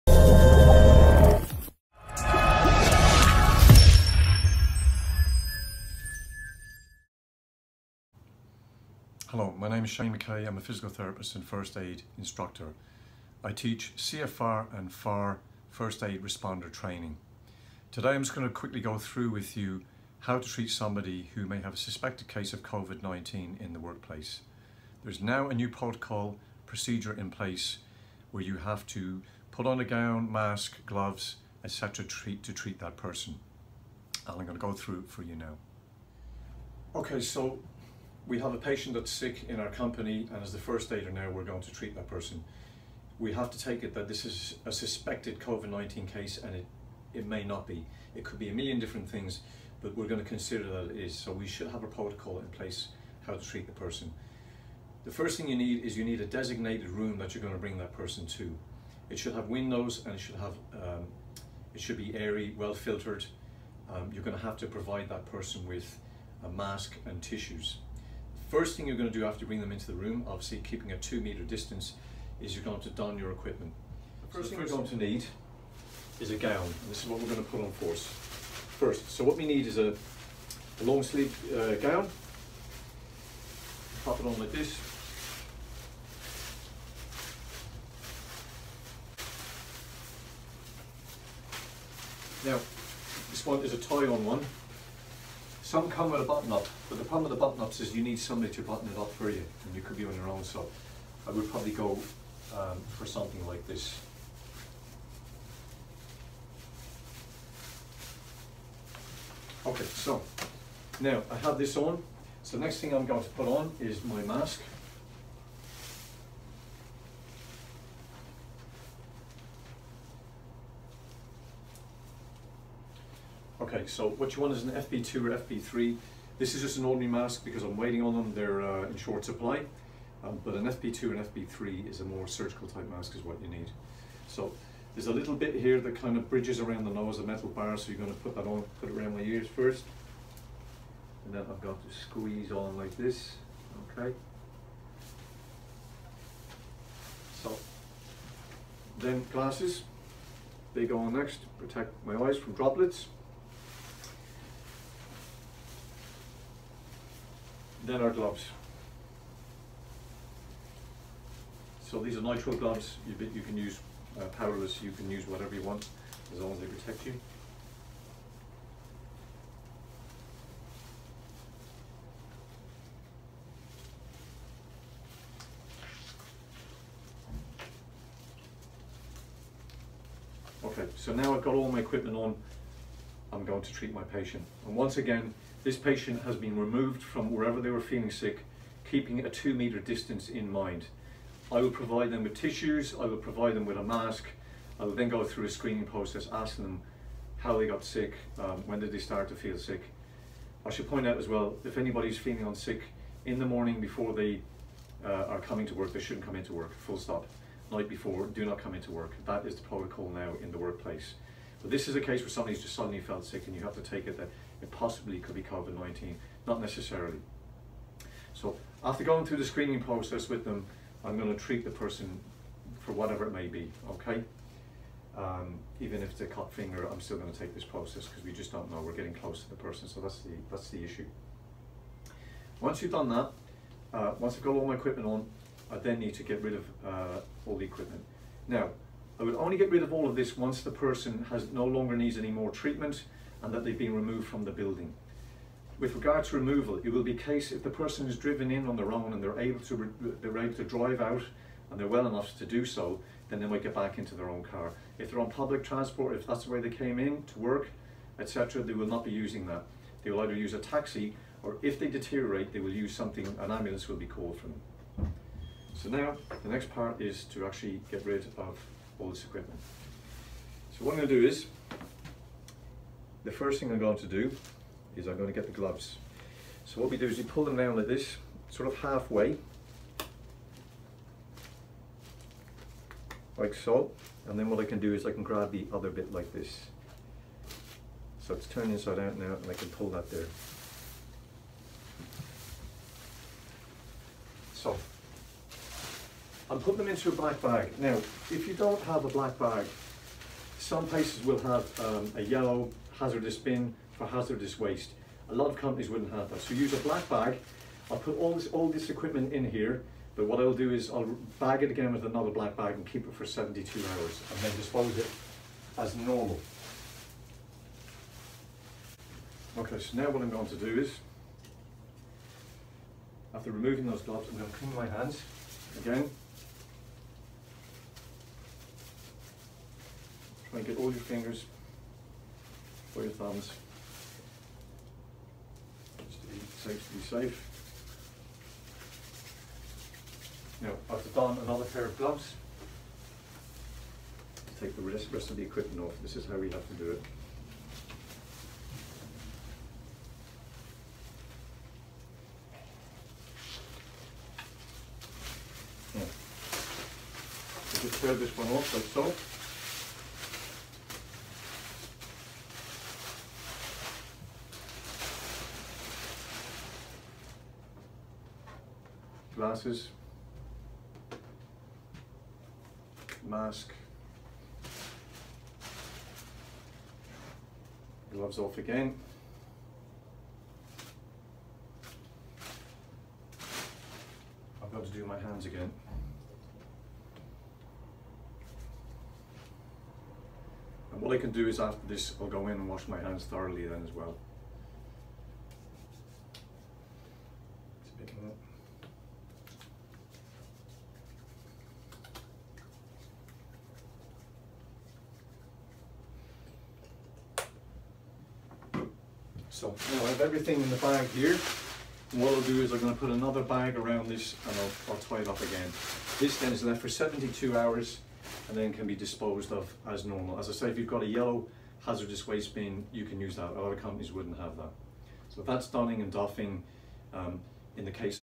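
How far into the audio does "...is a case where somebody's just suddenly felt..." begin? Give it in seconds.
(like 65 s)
211 s.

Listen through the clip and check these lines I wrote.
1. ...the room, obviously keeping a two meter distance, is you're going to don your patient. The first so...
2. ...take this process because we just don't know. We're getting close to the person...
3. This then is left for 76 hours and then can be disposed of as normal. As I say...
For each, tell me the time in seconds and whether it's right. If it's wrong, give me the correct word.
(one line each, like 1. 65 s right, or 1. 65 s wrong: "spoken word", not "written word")
1. 69 s wrong: "equipment", not "patient"
2. 227 s right
3. 416 s wrong: "72", not "76".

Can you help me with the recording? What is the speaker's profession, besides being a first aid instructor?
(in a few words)
physical therapist.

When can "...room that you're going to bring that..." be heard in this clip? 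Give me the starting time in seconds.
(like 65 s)
56 s.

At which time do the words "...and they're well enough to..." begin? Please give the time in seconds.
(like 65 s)
251 s.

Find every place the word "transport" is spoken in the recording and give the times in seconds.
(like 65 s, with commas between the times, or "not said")
255 s.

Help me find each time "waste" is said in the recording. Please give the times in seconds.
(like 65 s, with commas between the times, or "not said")
304 s, 422 s.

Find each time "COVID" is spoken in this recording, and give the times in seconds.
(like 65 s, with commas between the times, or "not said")
22 s, 45 s, 215 s.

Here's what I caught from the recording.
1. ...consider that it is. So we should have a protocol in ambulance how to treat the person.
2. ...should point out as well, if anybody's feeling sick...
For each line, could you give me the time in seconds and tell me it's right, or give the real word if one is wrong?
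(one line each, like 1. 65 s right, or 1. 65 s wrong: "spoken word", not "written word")
1. 50 s wrong: "place", not "ambulance"
2. 200 s right.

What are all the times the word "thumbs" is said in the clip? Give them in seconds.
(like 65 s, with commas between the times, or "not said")
333 s.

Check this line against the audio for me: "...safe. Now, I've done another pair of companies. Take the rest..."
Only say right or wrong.
wrong.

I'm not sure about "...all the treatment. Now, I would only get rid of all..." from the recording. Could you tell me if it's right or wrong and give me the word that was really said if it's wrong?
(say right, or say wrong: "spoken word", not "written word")
wrong: "equipment", not "treatment".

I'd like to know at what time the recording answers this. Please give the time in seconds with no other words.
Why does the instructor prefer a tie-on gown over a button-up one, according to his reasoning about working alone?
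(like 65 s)
97 s.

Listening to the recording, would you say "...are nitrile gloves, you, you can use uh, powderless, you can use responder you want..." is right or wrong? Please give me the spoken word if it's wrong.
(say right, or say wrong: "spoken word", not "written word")
wrong: "whatever", not "responder".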